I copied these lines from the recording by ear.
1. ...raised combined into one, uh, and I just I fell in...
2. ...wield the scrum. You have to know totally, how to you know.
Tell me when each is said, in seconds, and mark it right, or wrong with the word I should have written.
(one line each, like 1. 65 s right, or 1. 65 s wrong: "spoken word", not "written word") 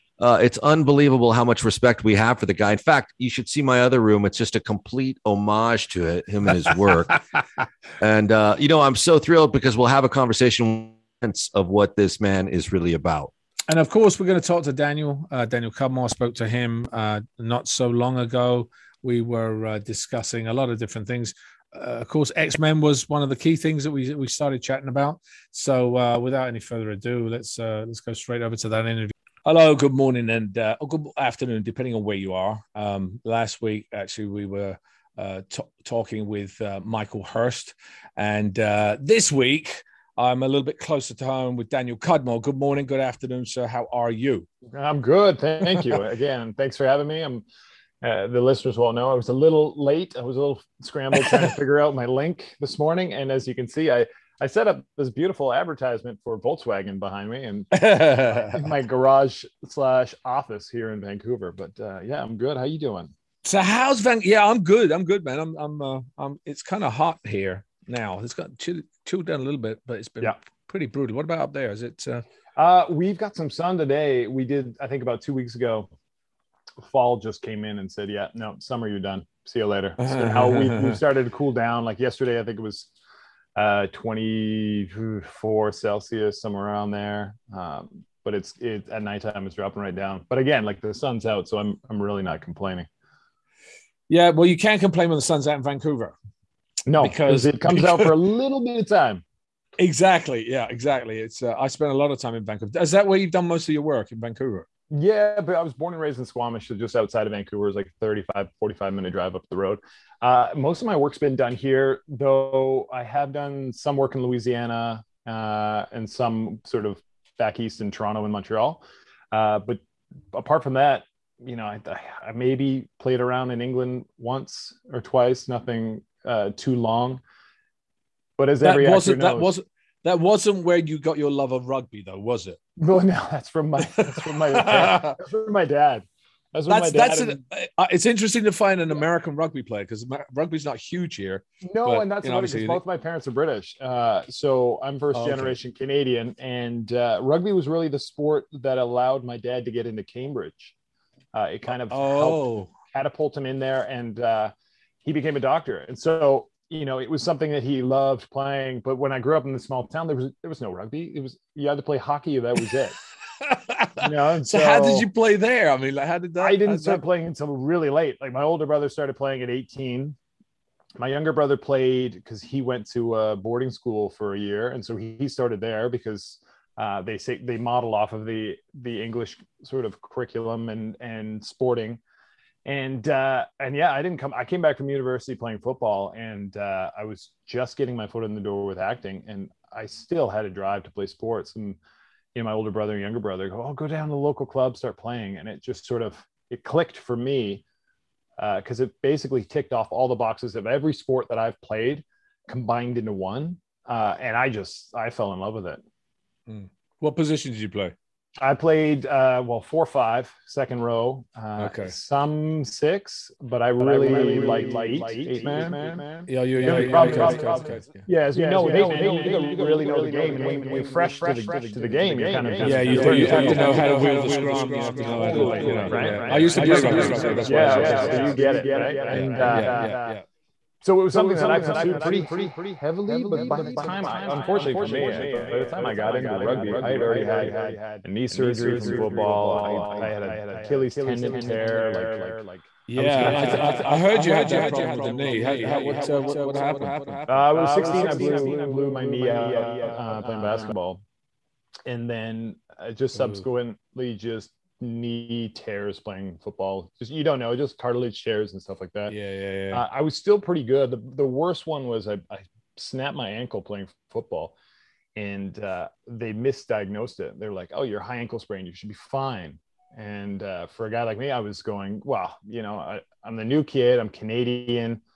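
1. 201 s wrong: "played", not "raised"
2. 223 s right.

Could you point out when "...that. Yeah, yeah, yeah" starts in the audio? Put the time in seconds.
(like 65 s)
258 s.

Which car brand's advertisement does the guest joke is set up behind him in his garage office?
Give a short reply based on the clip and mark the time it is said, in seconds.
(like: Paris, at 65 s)
Volkswagen, at 56 s.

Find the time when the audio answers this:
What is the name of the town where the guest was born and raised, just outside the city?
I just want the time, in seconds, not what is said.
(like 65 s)
106 s.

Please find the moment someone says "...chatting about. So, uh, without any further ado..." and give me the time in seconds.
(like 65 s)
24 s.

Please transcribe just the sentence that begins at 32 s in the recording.
Um, last week, actually, we were uh, t- talking with uh, Michael Hurst, and uh, this week.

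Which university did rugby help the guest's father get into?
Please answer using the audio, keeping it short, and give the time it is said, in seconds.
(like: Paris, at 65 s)
Cambridge, at 150 s.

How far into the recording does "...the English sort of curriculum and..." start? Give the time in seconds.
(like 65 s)
178 s.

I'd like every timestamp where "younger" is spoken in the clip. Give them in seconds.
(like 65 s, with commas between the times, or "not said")
171 s, 193 s.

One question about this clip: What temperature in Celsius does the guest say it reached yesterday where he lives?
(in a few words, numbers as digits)
24.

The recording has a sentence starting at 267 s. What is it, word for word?
They're like, "Oh, you're high ankle sprain.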